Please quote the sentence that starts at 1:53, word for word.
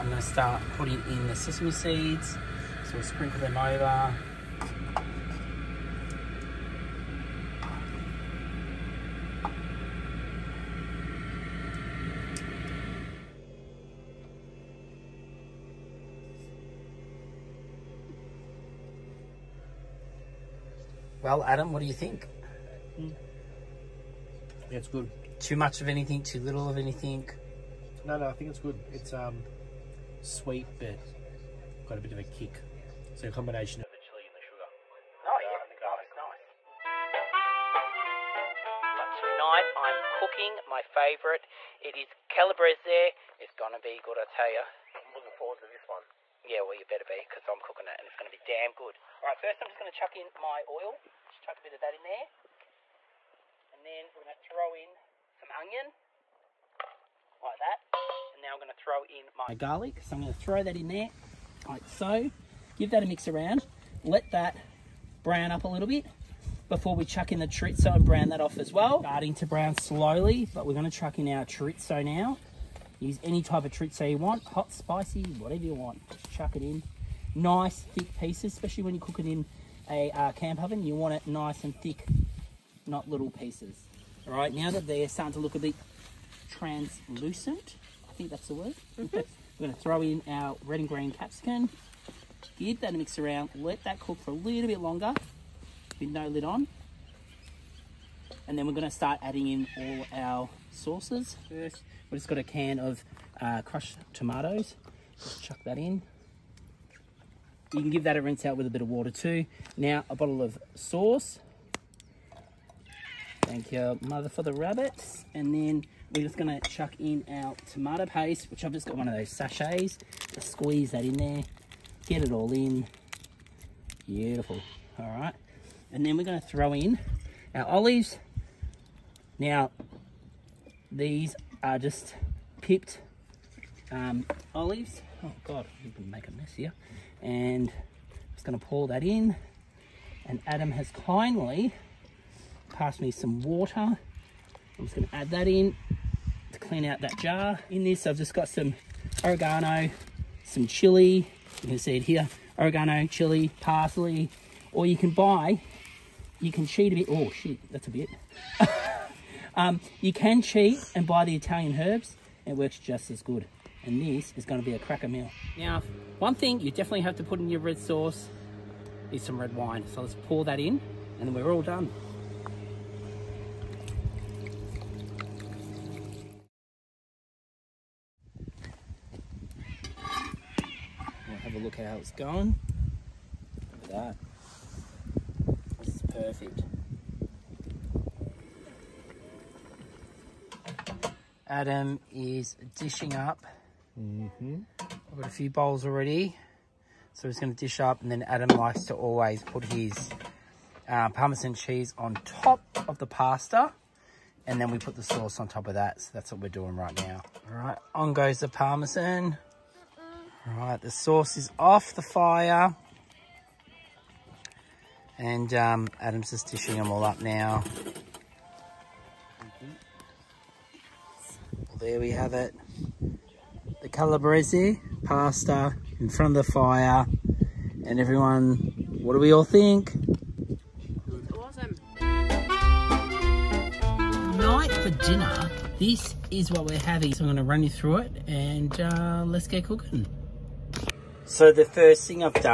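Thank you, mother, for the rabbits.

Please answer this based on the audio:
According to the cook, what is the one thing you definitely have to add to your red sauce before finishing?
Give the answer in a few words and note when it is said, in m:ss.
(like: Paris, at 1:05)
red wine, at 2:49.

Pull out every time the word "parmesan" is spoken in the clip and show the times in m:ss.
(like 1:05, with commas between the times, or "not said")
3:21, 3:28.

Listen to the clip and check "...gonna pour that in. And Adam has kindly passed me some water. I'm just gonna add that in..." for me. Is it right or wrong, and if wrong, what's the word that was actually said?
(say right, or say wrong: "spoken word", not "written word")
right.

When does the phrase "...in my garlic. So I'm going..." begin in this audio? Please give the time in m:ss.
0:59.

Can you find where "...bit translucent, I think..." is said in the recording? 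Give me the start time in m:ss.
1:25.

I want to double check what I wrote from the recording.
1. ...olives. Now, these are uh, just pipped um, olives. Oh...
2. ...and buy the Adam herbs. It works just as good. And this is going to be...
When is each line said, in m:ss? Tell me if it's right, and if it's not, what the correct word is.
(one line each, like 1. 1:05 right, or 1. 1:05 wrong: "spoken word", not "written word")
1. 2:07 right
2. 2:40 wrong: "Italian", not "Adam".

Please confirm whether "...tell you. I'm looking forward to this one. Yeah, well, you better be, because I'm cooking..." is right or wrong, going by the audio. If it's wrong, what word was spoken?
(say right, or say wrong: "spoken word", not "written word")
right.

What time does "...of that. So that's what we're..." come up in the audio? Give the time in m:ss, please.
3:25.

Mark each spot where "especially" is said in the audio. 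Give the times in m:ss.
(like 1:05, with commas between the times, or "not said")
1:18.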